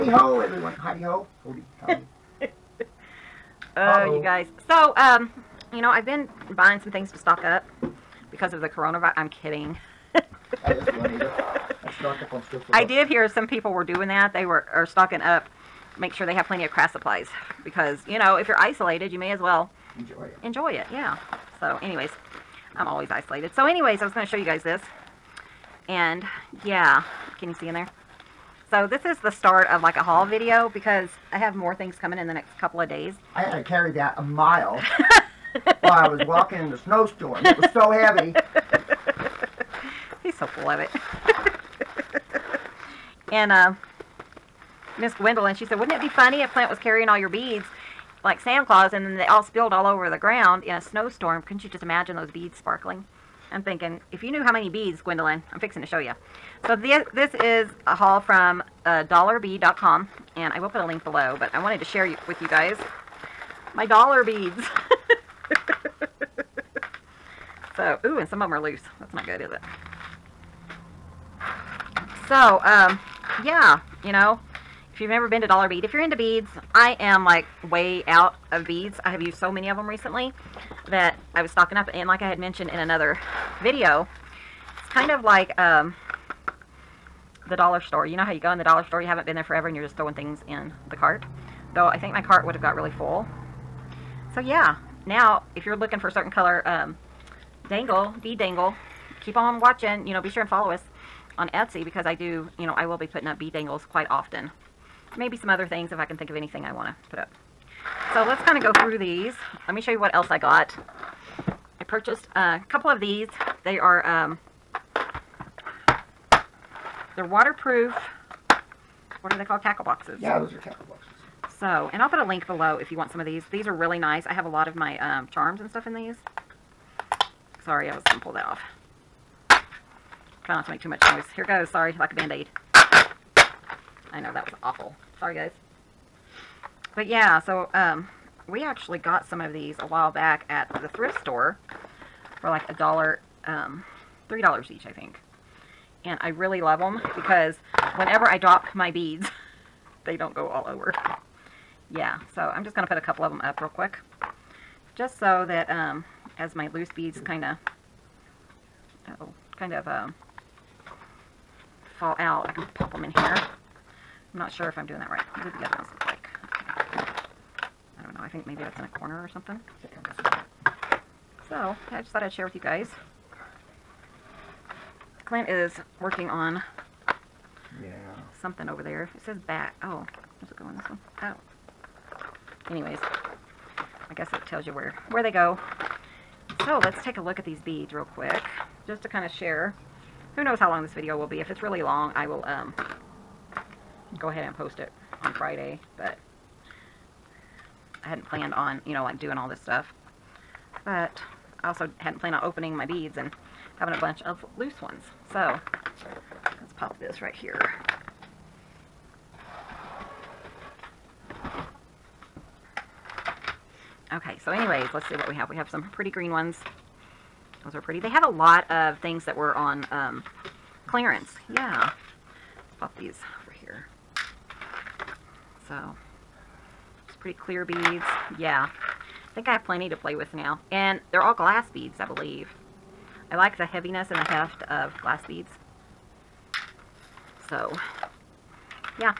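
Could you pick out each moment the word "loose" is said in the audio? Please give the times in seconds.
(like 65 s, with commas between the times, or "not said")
68 s, 156 s, 204 s.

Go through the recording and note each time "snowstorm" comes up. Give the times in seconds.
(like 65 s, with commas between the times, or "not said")
36 s, 50 s.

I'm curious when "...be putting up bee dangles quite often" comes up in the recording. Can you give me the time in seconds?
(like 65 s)
102 s.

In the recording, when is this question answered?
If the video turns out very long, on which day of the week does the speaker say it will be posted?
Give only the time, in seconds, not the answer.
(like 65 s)
195 s.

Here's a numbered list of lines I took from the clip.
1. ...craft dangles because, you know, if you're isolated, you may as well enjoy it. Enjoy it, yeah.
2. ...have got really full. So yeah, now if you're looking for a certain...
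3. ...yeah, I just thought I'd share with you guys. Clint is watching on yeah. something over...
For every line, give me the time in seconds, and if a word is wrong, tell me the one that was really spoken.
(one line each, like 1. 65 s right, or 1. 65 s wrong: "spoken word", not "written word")
1. 16 s wrong: "supplies", not "dangles"
2. 92 s right
3. 171 s wrong: "working", not "watching".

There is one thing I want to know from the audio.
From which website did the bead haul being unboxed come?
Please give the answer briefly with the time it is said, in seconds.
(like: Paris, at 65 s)
dollarbead.com, at 59 s.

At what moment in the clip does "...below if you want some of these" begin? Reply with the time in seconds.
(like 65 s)
122 s.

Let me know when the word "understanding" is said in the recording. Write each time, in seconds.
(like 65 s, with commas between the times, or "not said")
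not said.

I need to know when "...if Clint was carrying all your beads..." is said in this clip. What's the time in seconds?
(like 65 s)
46 s.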